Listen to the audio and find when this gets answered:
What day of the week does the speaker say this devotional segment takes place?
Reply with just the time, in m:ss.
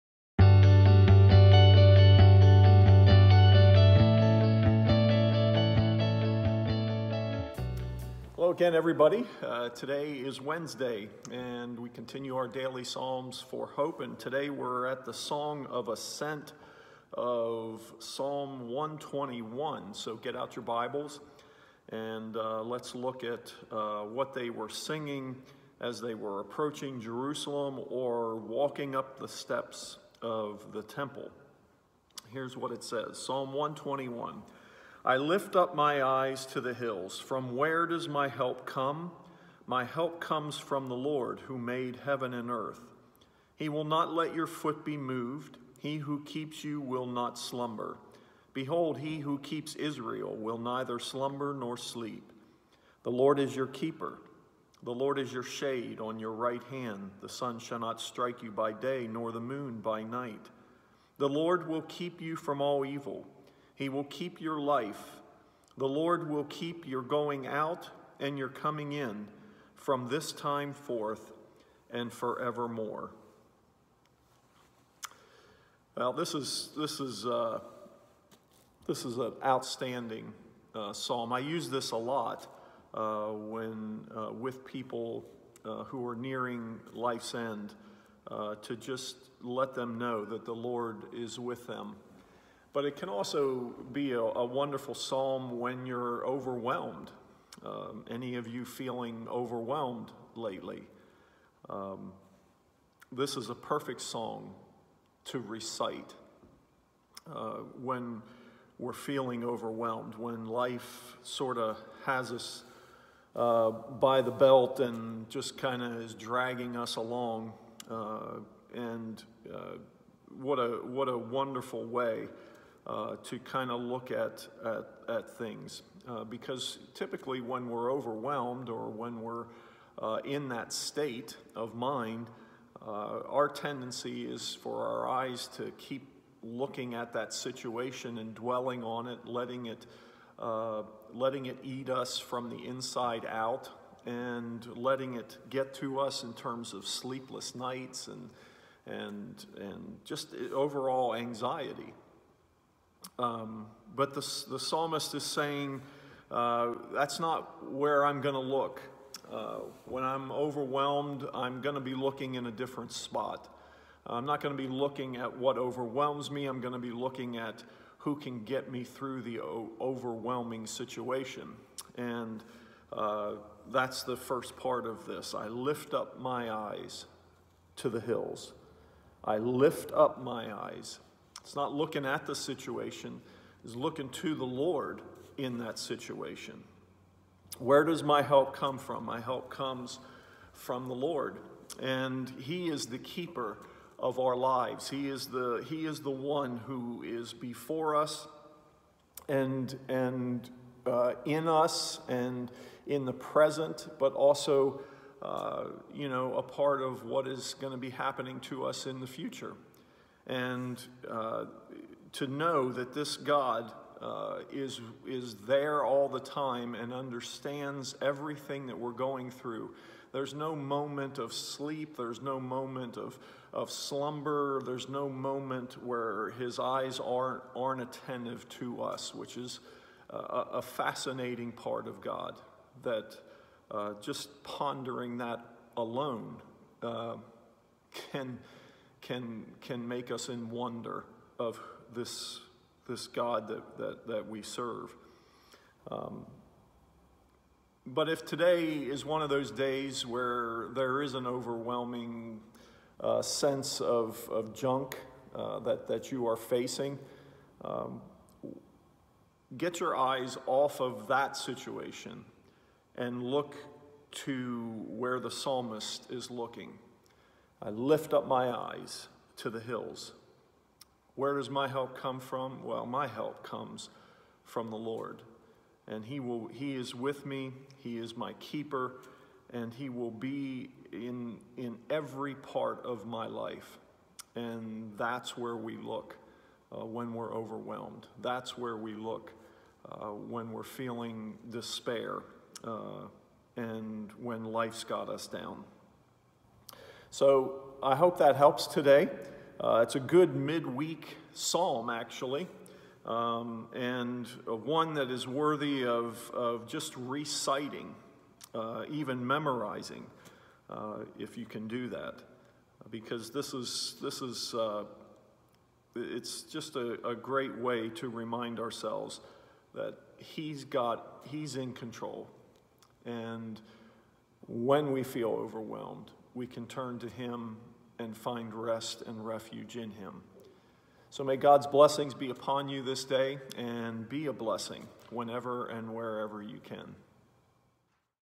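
0:10.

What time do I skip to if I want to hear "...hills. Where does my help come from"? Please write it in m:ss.
4:29.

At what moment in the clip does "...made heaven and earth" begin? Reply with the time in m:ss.
0:41.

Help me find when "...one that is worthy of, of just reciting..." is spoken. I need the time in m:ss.
5:04.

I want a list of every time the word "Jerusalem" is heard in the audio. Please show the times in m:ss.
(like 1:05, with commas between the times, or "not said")
0:26.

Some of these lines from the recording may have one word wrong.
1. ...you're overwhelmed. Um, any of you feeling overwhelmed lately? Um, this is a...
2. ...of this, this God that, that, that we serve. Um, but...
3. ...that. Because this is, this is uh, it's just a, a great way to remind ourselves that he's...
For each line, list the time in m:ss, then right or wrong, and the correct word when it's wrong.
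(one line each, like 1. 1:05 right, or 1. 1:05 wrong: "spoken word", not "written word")
1. 1:35 right
2. 4:01 right
3. 5:11 right.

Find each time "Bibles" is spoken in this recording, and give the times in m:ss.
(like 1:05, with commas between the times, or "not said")
0:20.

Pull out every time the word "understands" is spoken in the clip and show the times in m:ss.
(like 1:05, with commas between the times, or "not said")
3:36.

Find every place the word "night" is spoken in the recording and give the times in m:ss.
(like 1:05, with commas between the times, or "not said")
1:00, 2:27.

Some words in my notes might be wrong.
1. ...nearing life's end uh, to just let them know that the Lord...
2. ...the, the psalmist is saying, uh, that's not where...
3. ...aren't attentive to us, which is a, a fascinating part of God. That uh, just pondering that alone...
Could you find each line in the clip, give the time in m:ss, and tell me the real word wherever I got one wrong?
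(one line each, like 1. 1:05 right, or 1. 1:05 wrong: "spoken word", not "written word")
1. 1:26 right
2. 2:34 right
3. 3:47 right.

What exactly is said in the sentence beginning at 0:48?
Behold, he who keeps Israel will neither slumber nor sleep.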